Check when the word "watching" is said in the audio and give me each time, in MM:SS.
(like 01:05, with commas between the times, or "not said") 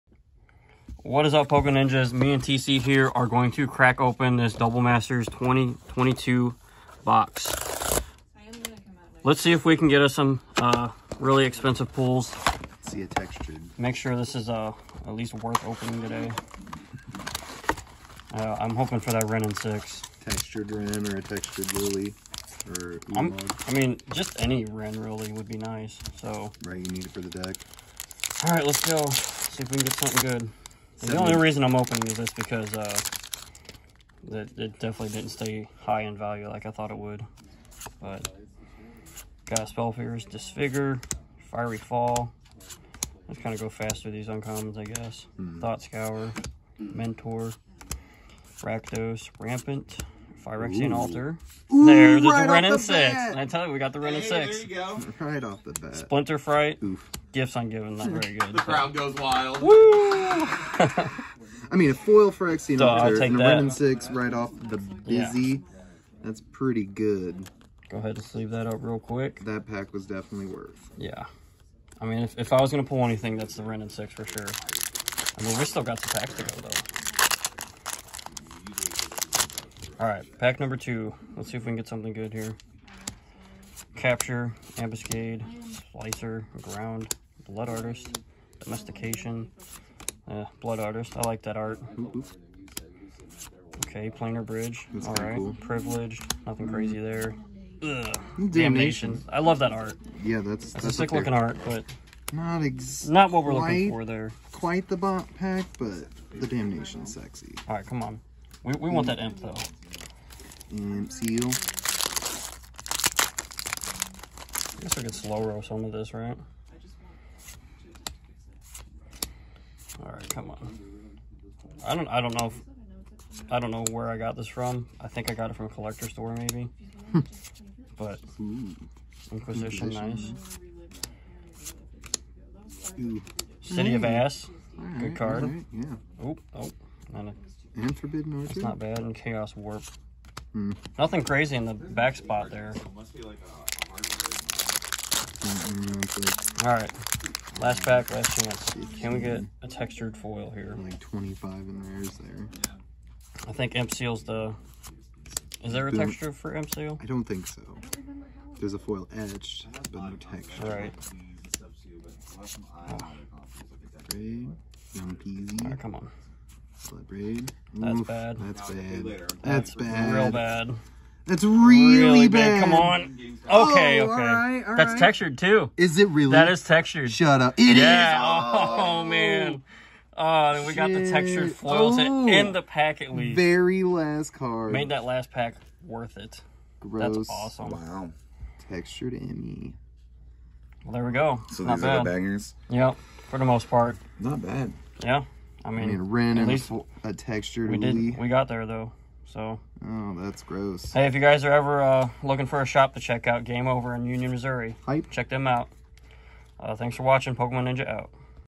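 03:27.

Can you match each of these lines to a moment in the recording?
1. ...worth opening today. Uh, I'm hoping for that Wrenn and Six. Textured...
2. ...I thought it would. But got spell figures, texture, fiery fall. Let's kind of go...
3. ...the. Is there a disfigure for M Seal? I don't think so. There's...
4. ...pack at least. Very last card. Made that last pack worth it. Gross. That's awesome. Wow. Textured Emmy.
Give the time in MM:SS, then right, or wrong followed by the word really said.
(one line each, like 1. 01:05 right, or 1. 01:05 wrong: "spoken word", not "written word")
1. 00:15 right
2. 00:36 wrong: "disfigure", not "texture"
3. 02:34 wrong: "texture", not "disfigure"
4. 03:02 right.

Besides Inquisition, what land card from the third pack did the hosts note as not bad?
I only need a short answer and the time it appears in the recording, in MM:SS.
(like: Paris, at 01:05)
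Forbidden Orchard, at 02:17.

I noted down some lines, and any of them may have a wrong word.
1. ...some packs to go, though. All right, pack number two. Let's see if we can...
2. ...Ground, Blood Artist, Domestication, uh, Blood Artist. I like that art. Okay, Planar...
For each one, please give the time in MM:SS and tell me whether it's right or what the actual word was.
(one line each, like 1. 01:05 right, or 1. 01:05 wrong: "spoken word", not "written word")
1. 01:15 right
2. 01:26 right.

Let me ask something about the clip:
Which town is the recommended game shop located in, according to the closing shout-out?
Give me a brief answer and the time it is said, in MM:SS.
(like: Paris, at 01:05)
Union, Missouri, at 03:24.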